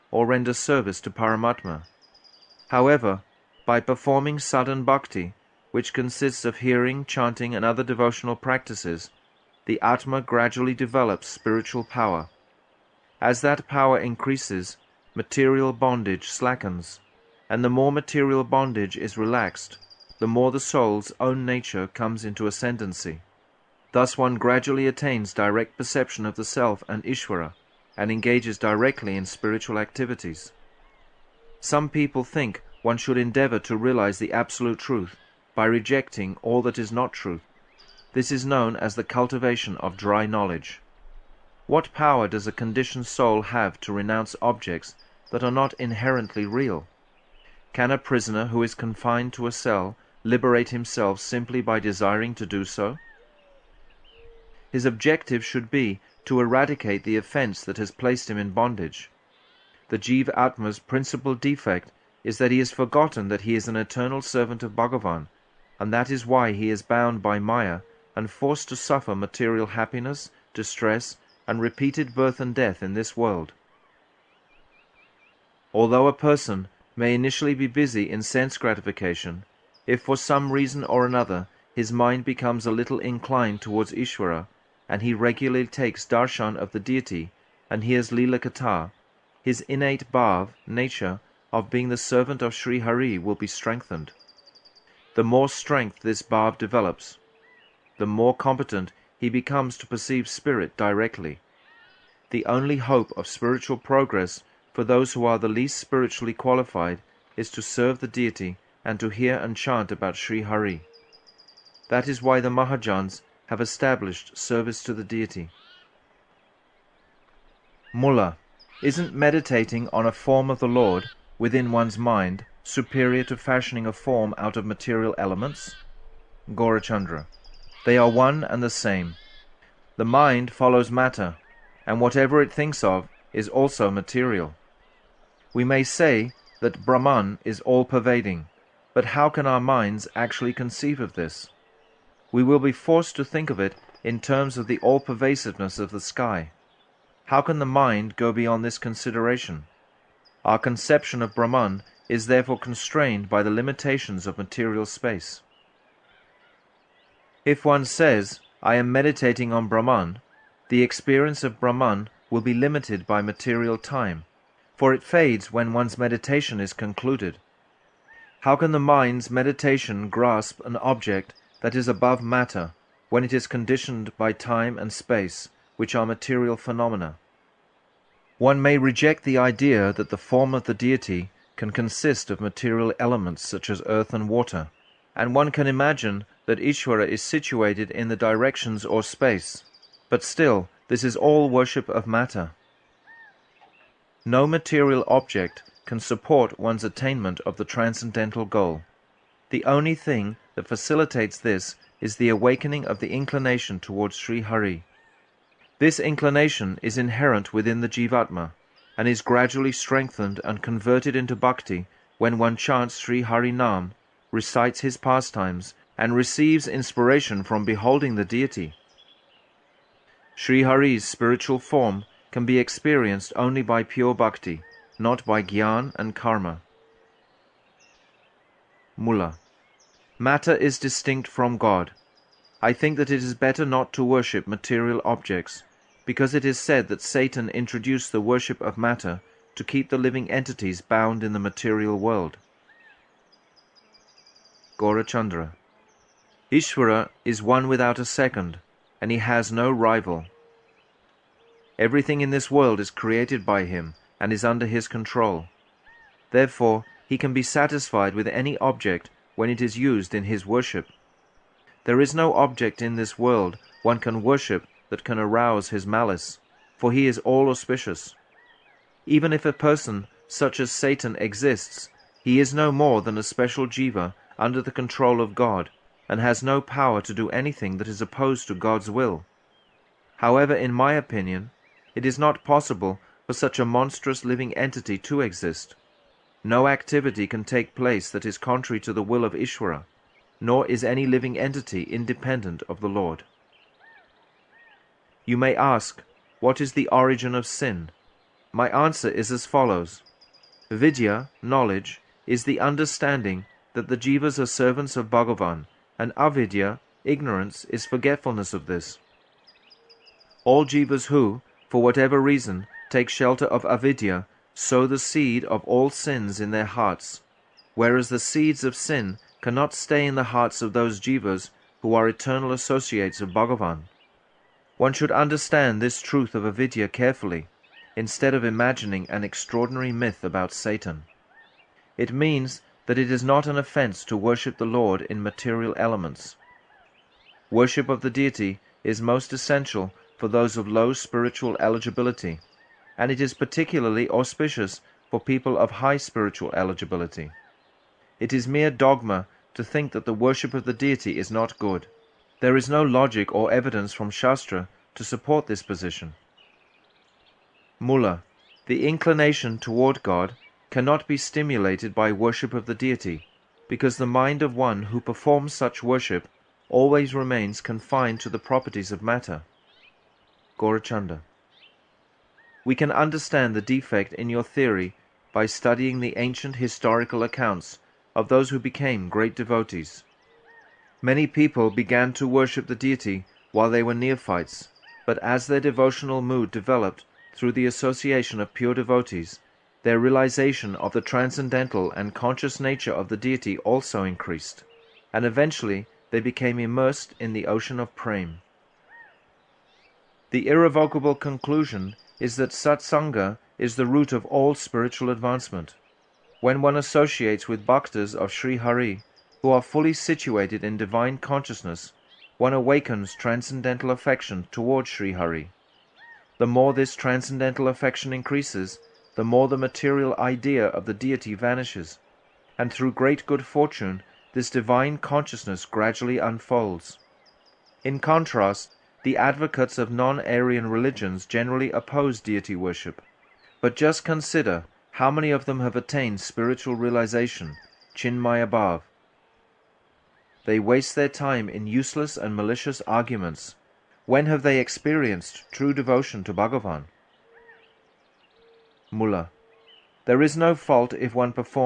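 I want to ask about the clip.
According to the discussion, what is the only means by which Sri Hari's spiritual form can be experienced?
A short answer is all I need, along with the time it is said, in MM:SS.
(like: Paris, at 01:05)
Pure bhakti, at 03:43.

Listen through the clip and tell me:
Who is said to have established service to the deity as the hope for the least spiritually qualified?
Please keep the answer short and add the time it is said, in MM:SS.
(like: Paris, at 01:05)
The Mahajans, at 01:52.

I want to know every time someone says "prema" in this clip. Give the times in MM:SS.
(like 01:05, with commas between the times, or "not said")
06:37.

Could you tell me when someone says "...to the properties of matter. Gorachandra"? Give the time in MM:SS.
06:08.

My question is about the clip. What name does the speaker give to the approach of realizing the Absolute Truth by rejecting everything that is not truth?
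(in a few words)
Cultivation of dry knowledge.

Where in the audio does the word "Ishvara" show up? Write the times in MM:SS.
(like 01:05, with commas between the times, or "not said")
00:27, 04:06, 04:49.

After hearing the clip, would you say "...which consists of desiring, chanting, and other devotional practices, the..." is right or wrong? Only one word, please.
wrong.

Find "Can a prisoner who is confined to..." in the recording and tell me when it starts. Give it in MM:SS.
00:47.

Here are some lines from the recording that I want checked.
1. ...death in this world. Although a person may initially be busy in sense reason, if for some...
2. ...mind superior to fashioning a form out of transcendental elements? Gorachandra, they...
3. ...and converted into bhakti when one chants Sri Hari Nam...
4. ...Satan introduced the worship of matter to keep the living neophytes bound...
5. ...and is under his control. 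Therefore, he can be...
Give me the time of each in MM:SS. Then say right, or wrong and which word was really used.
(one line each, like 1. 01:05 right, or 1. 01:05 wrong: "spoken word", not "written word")
1. 01:12 wrong: "gratification", not "reason"
2. 02:01 wrong: "material", not "transcendental"
3. 03:30 right
4. 03:57 wrong: "entities", not "neophytes"
5. 04:14 right.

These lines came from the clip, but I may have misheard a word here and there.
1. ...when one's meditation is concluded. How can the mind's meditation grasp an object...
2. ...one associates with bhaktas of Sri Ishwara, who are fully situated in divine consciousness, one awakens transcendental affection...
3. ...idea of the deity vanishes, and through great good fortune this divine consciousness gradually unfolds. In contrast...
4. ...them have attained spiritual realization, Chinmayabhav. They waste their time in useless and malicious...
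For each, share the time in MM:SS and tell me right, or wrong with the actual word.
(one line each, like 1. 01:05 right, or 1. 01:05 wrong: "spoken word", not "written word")
1. 02:45 right
2. 06:46 wrong: "Hari", not "Ishwara"
3. 07:00 right
4. 07:15 right.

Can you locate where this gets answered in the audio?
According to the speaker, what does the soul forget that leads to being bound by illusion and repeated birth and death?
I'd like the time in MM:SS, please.
01:03.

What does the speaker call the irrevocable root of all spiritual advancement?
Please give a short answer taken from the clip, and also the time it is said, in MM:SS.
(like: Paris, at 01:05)
Satsanga, at 06:42.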